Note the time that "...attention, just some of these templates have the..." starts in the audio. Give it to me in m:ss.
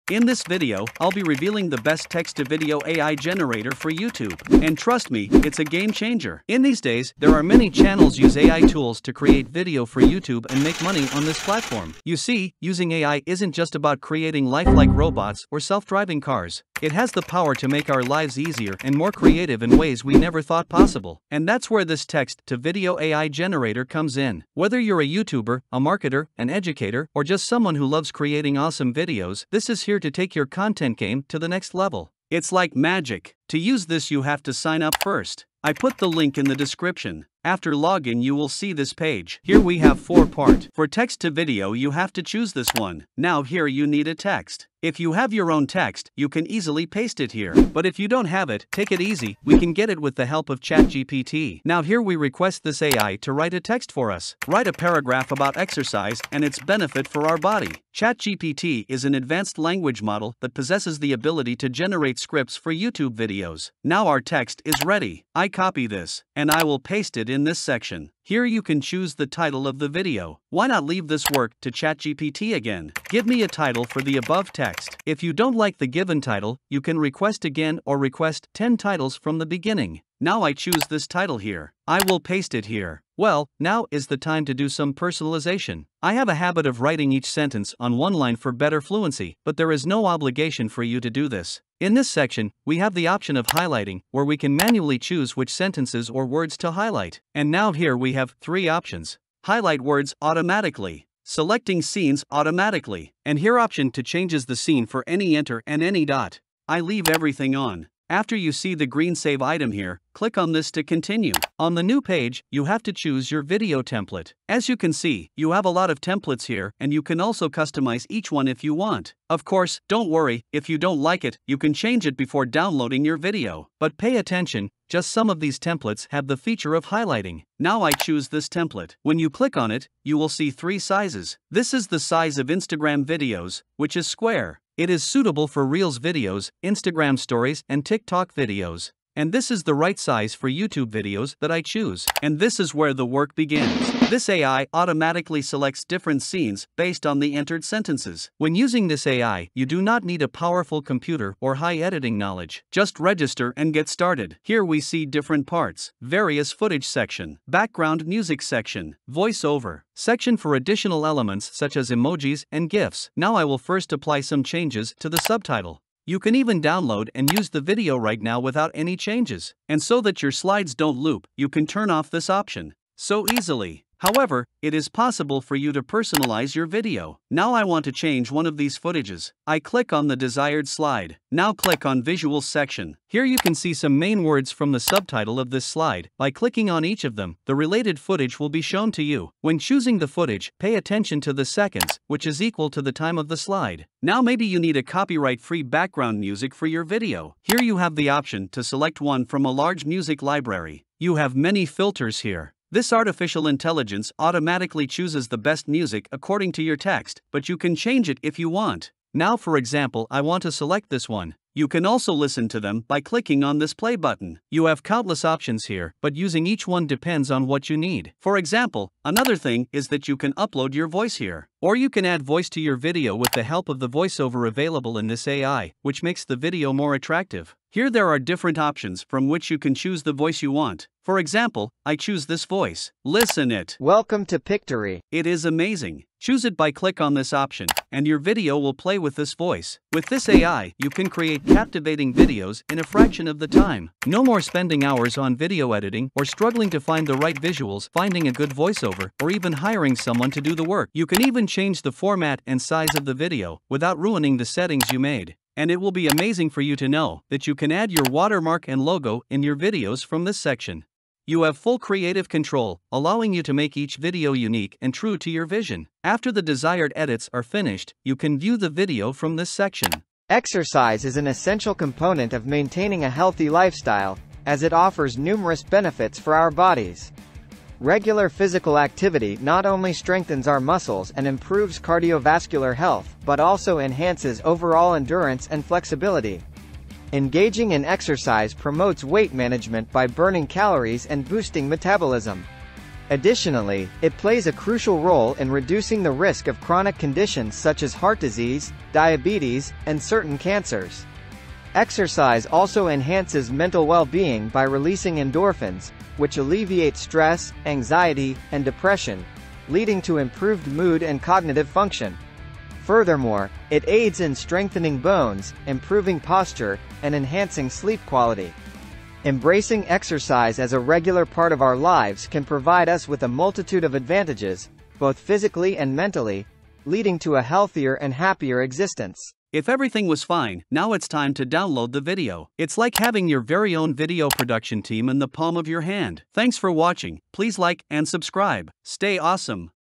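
2:04.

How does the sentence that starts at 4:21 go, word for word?
You have full creative control, allowing you to make each video unique and true to your vision.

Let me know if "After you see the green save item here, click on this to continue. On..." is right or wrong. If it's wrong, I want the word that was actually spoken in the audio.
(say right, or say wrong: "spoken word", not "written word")
right.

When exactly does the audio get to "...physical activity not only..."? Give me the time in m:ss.
4:38.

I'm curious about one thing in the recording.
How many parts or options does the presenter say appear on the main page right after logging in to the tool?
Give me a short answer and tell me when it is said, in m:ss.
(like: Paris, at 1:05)
4, at 0:39.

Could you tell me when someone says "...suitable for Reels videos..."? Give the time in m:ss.
2:15.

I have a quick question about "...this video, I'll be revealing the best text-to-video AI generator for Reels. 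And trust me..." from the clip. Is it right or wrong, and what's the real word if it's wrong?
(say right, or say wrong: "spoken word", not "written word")
wrong: "YouTube", not "Reels".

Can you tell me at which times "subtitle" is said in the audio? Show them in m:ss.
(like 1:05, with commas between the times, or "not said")
2:45, 3:04.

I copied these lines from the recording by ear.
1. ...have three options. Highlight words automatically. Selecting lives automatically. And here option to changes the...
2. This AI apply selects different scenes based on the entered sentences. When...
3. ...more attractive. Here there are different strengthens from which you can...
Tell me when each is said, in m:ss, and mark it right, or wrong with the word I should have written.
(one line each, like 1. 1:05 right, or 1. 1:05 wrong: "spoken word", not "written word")
1. 1:38 wrong: "scenes", not "lives"
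2. 2:24 wrong: "automatically", not "apply"
3. 3:46 wrong: "options", not "strengthens".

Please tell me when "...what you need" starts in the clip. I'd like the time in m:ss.
3:37.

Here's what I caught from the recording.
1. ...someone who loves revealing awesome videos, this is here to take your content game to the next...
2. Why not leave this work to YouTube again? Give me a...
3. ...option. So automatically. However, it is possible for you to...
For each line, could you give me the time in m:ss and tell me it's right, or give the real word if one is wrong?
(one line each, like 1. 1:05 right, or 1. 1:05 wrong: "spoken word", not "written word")
1. 0:27 wrong: "creating", not "revealing"
2. 1:10 wrong: "ChatGPT", not "YouTube"
3. 2:52 wrong: "easily", not "automatically".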